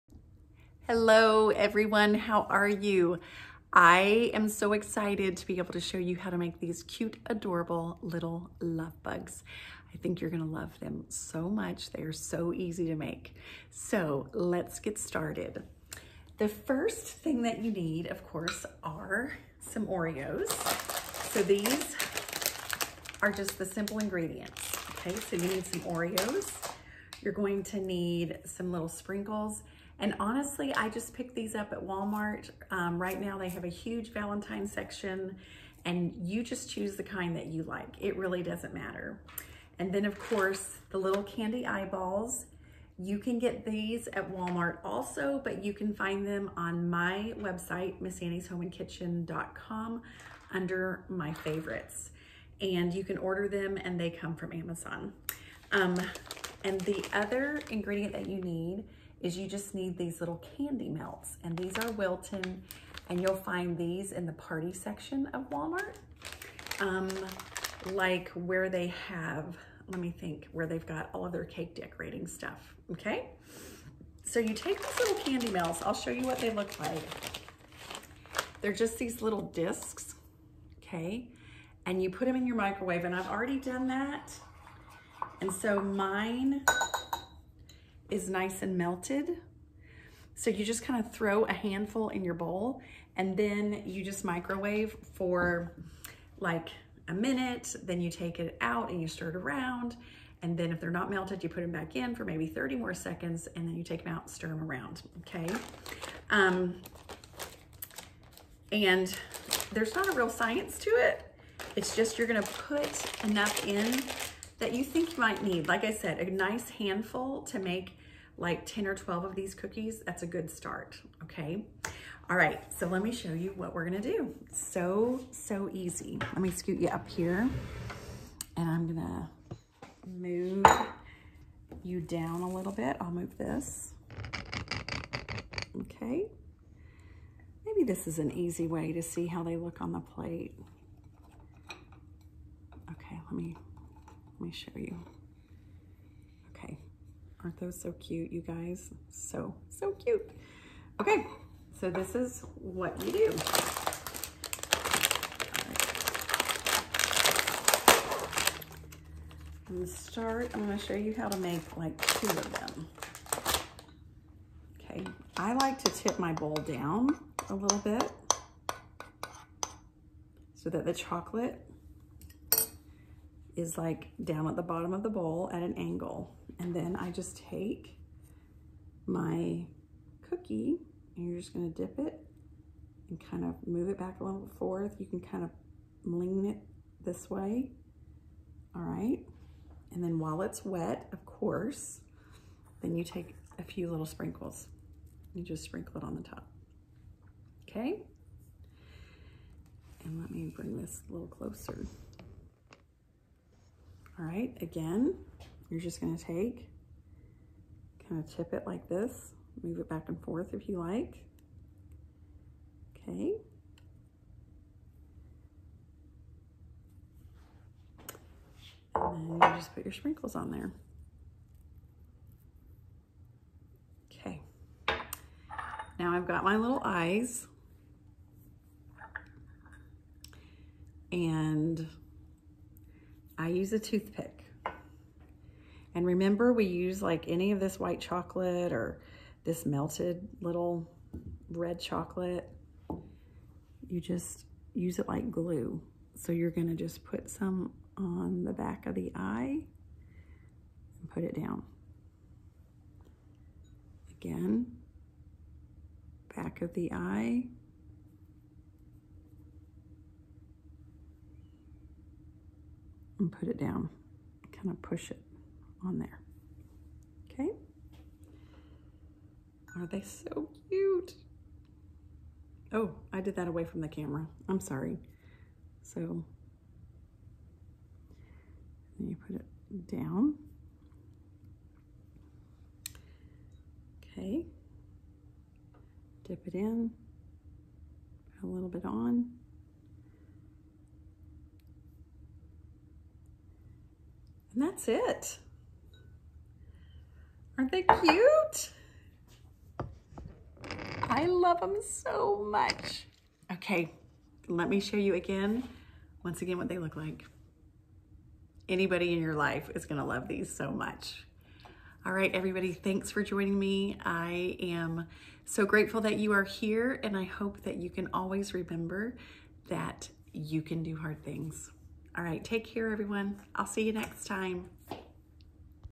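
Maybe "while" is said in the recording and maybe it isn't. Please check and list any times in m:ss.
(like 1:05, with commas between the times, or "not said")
3:10.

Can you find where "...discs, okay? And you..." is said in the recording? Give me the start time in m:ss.
1:19.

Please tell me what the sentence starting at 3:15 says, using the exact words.
You just sprinkle it on the top, okay?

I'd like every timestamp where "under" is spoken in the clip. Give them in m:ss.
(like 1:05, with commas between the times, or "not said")
0:50.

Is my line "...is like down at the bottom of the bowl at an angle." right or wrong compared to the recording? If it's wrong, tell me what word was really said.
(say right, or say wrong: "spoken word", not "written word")
right.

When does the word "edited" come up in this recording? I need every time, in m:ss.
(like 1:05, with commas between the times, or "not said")
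not said.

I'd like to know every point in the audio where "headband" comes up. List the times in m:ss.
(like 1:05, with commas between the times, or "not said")
not said.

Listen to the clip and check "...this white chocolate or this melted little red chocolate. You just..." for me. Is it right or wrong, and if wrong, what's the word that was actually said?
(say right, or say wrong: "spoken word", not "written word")
right.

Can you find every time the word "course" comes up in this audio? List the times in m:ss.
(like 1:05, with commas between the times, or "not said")
0:18, 0:40, 3:11.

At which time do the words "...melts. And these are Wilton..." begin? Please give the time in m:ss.
1:00.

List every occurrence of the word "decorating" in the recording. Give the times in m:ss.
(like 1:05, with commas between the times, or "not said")
1:11.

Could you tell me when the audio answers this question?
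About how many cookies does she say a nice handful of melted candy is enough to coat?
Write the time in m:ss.
1:58.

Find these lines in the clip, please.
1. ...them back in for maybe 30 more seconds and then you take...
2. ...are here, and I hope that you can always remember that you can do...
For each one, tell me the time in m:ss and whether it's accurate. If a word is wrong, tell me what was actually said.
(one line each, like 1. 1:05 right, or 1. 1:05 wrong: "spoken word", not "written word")
1. 1:41 right
2. 5:16 right.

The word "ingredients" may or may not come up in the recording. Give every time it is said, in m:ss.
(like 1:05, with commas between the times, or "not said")
0:23, 0:57.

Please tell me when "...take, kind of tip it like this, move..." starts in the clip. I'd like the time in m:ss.
3:26.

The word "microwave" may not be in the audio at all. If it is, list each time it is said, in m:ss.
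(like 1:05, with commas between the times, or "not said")
1:22, 1:34.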